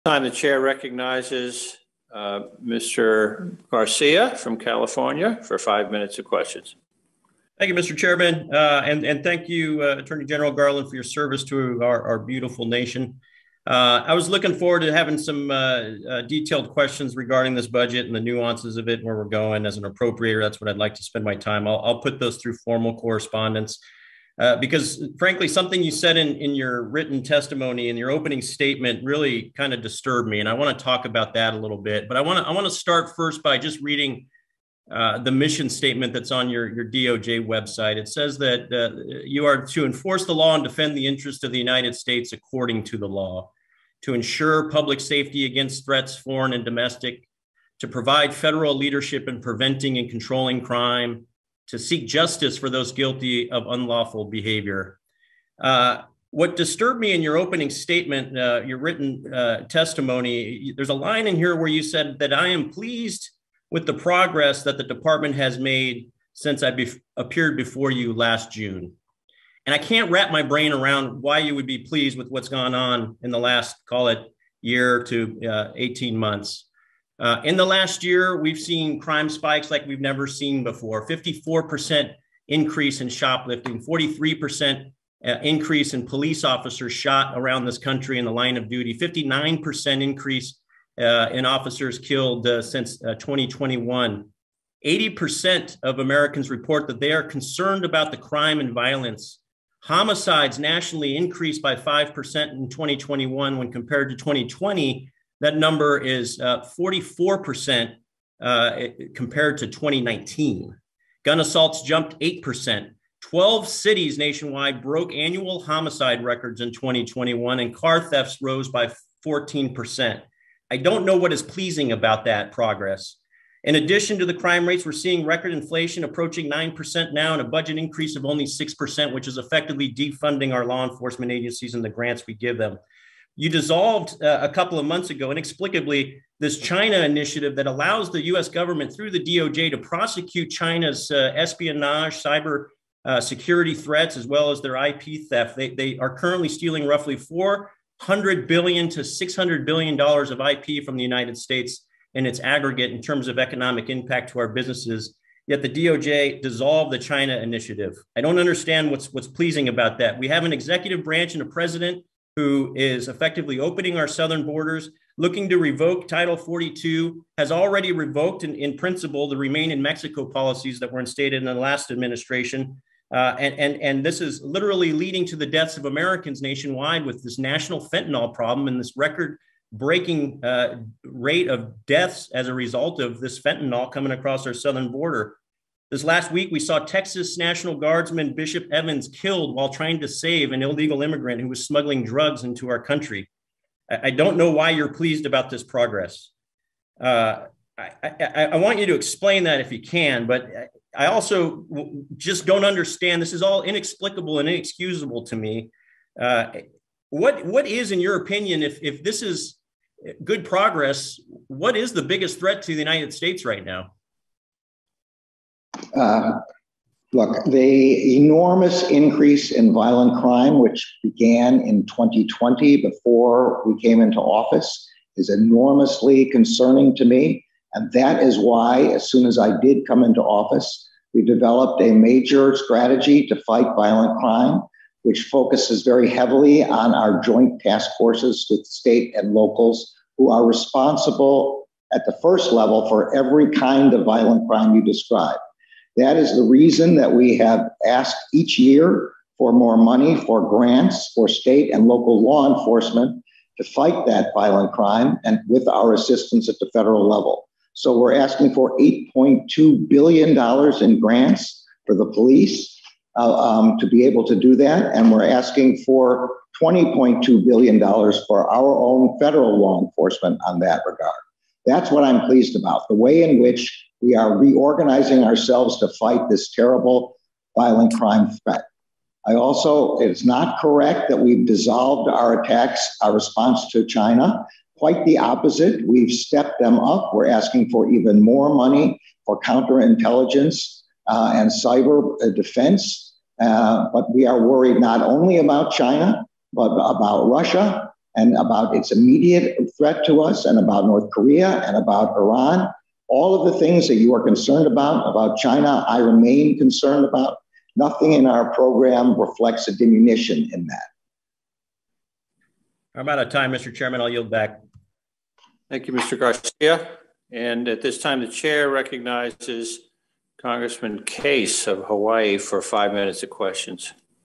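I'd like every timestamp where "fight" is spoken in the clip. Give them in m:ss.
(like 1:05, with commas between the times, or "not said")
3:53, 4:13, 4:35.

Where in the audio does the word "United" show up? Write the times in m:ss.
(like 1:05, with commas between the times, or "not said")
0:41, 2:31, 3:32.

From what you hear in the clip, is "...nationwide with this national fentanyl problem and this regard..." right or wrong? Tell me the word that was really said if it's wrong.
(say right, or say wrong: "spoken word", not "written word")
wrong: "record", not "regard".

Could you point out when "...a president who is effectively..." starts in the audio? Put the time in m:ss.
2:41.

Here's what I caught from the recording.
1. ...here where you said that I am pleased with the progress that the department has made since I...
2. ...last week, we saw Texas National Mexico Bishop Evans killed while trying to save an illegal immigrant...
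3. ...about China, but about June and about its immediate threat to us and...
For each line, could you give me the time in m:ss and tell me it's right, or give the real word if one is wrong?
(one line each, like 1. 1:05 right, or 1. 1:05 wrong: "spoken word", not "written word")
1. 1:01 right
2. 3:06 wrong: "Guardsman", not "Mexico"
3. 4:55 wrong: "Russia", not "June".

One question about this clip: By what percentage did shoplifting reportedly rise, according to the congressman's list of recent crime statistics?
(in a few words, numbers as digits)
54%.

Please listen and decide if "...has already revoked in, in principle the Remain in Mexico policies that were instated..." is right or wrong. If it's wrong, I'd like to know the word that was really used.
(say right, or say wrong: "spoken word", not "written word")
right.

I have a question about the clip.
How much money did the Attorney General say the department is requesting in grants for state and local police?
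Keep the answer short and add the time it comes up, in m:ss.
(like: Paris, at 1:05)
$8.2 billion, at 4:18.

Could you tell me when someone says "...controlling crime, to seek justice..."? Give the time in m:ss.
0:50.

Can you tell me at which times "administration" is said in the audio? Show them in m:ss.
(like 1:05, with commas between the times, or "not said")
2:51.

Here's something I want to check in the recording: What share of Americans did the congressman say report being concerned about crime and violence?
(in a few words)
80%.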